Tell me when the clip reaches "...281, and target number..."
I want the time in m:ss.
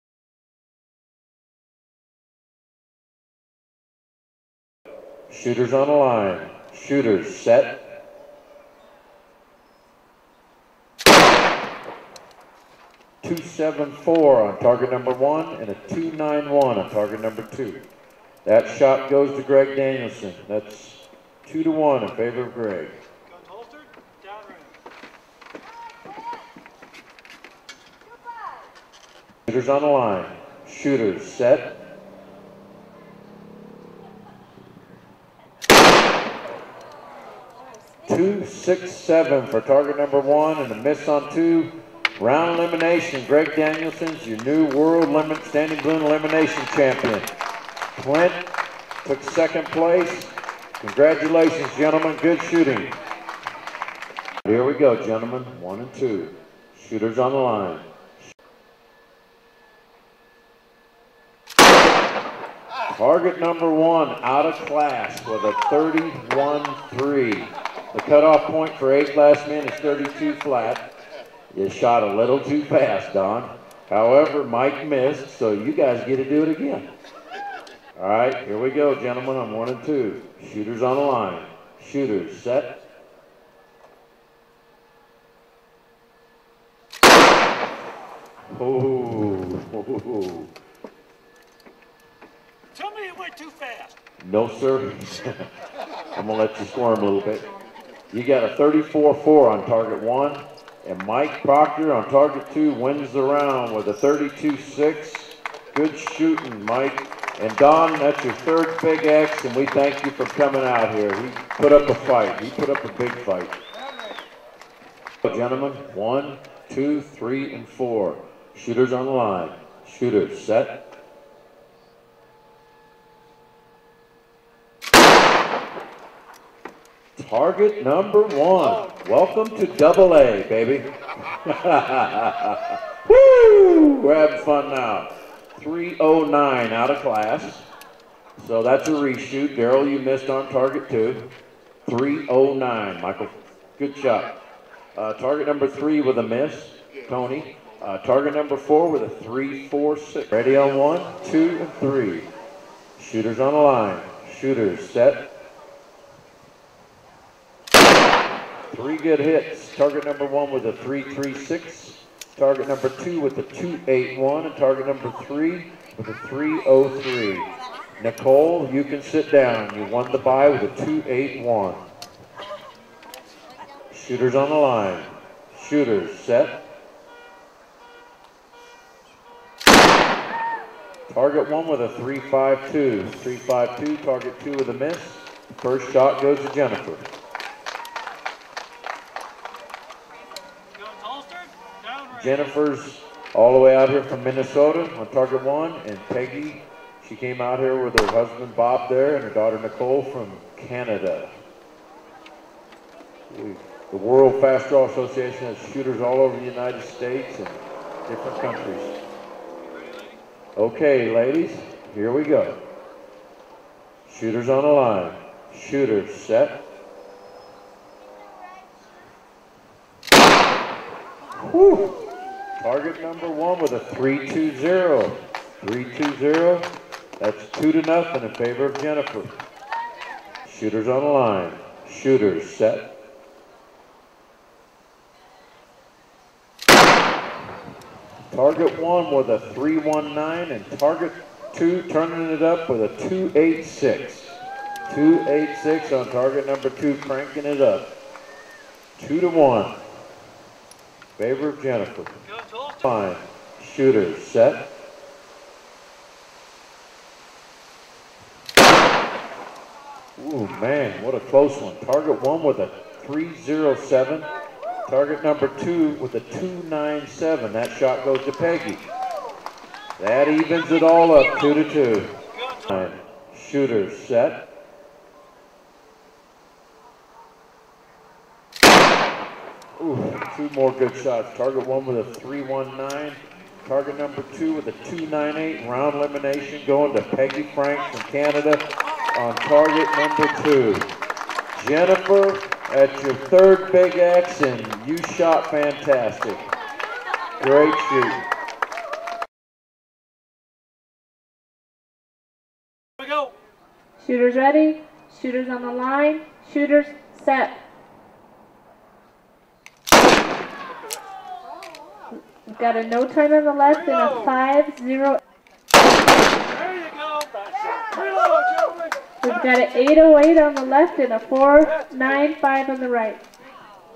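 2:43.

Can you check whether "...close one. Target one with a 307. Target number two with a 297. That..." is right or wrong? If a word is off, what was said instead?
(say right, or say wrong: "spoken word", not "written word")
right.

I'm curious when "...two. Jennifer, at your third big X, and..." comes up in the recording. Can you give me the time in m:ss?
4:50.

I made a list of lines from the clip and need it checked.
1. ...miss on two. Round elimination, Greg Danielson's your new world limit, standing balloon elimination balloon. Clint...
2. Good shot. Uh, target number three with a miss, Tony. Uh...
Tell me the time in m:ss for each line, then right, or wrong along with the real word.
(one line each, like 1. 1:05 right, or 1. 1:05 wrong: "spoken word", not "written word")
1. 0:40 wrong: "champion", not "balloon"
2. 2:23 right.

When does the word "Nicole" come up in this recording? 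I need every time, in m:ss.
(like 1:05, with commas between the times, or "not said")
2:48, 3:19.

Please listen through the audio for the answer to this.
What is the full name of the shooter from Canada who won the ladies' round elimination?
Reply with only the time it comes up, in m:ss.
4:47.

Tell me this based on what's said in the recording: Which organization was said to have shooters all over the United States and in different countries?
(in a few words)
World Fast Draw Association.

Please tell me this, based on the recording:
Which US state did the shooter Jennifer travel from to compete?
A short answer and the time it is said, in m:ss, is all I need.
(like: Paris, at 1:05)
Minnesota, at 3:14.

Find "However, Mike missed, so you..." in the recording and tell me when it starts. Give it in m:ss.
1:13.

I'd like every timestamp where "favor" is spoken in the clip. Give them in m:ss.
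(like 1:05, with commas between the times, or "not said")
0:22, 3:48, 4:11.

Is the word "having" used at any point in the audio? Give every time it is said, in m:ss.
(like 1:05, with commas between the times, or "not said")
2:14.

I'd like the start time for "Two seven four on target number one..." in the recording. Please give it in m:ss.
0:13.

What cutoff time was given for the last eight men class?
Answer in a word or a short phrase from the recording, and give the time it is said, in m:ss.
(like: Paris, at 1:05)
32 flat, at 1:09.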